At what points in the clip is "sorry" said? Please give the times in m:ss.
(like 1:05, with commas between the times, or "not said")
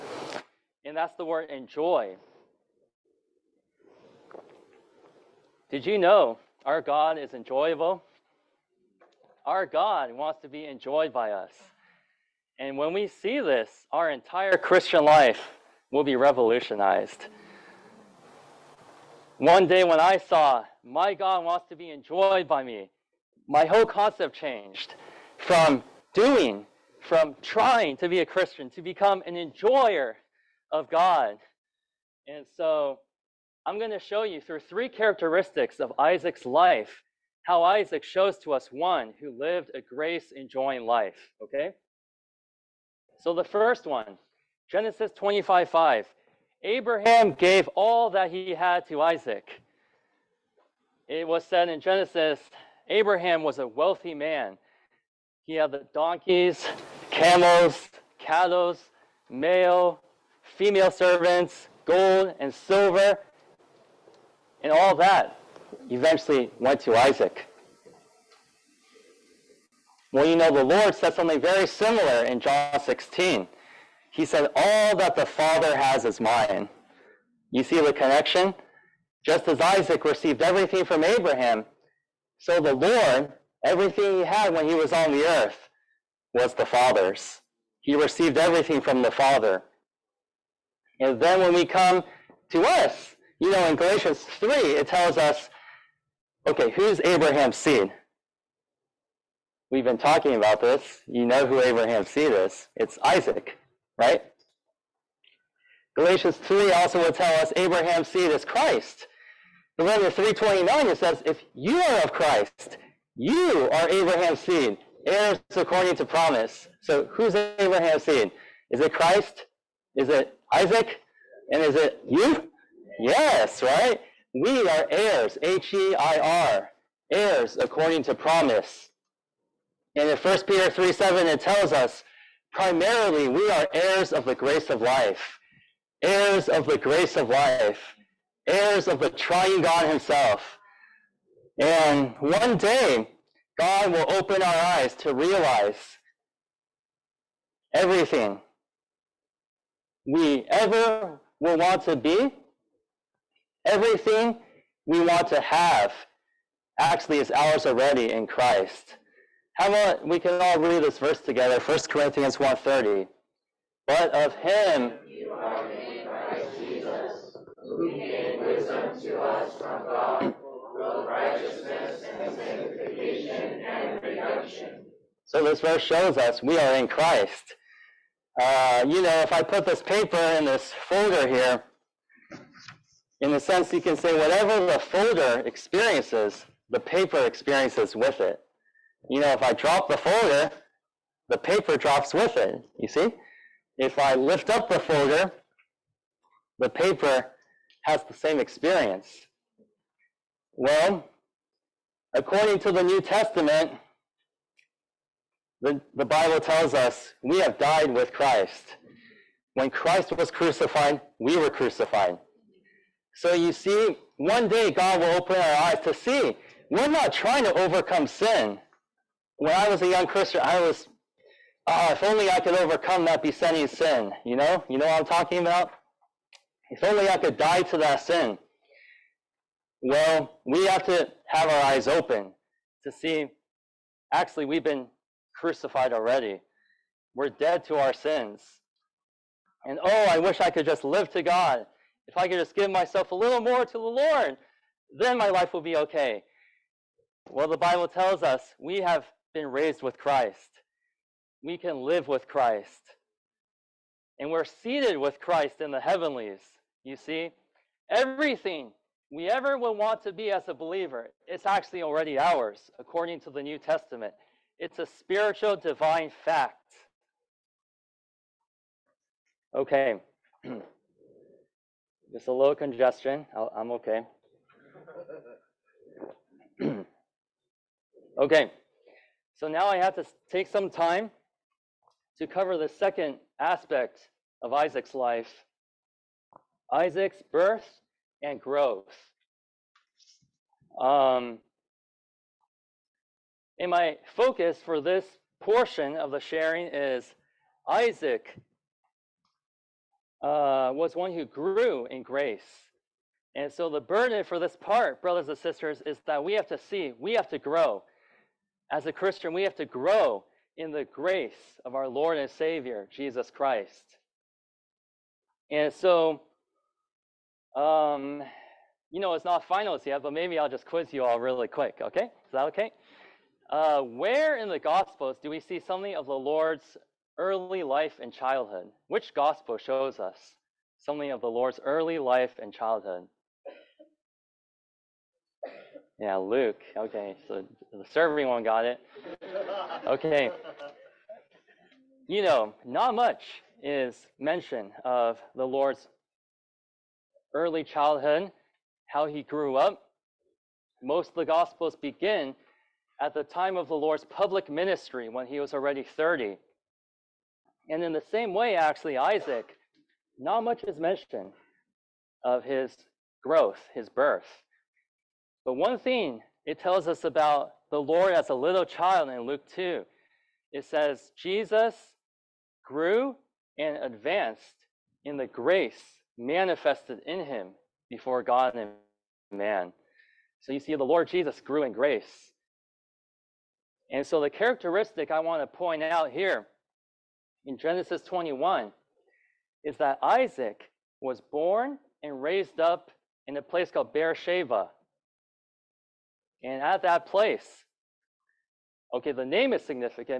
not said.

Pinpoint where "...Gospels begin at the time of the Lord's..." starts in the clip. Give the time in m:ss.
5:51.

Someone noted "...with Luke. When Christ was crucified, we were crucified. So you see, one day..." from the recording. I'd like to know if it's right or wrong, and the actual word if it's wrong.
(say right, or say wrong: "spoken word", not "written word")
wrong: "Christ", not "Luke".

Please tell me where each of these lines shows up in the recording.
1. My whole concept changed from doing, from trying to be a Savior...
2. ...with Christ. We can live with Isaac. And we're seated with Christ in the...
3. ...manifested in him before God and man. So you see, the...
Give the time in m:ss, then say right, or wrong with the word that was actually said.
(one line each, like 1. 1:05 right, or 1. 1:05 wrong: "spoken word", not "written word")
1. 0:23 wrong: "Christian", not "Savior"
2. 4:09 wrong: "Christ", not "Isaac"
3. 6:16 right.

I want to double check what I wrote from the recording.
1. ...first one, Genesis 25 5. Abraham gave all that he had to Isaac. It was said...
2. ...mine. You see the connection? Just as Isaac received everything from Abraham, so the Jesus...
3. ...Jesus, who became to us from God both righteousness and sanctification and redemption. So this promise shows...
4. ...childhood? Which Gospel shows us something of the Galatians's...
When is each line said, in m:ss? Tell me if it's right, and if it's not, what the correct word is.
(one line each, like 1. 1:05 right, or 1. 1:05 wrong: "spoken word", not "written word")
1. 0:43 right
2. 1:16 wrong: "Lord", not "Jesus"
3. 2:46 wrong: "verse", not "promise"
4. 5:28 wrong: "Lord", not "Galatians".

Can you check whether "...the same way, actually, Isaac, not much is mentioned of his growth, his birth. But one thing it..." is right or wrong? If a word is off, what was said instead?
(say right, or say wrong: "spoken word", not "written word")
right.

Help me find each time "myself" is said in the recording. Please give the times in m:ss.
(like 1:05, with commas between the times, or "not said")
4:02.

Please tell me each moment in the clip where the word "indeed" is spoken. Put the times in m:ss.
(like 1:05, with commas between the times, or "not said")
not said.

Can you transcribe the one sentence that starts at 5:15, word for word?
And so um, you know, it's not finals yet, but maybe I'll just quiz you all really quick, okay?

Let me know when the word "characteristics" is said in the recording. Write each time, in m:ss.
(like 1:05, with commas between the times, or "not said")
0:34, 6:24.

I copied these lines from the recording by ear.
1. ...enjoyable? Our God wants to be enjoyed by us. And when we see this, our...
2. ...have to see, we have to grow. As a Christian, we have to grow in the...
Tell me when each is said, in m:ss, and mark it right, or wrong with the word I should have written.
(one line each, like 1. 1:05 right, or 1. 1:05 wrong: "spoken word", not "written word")
1. 0:07 right
2. 5:06 right.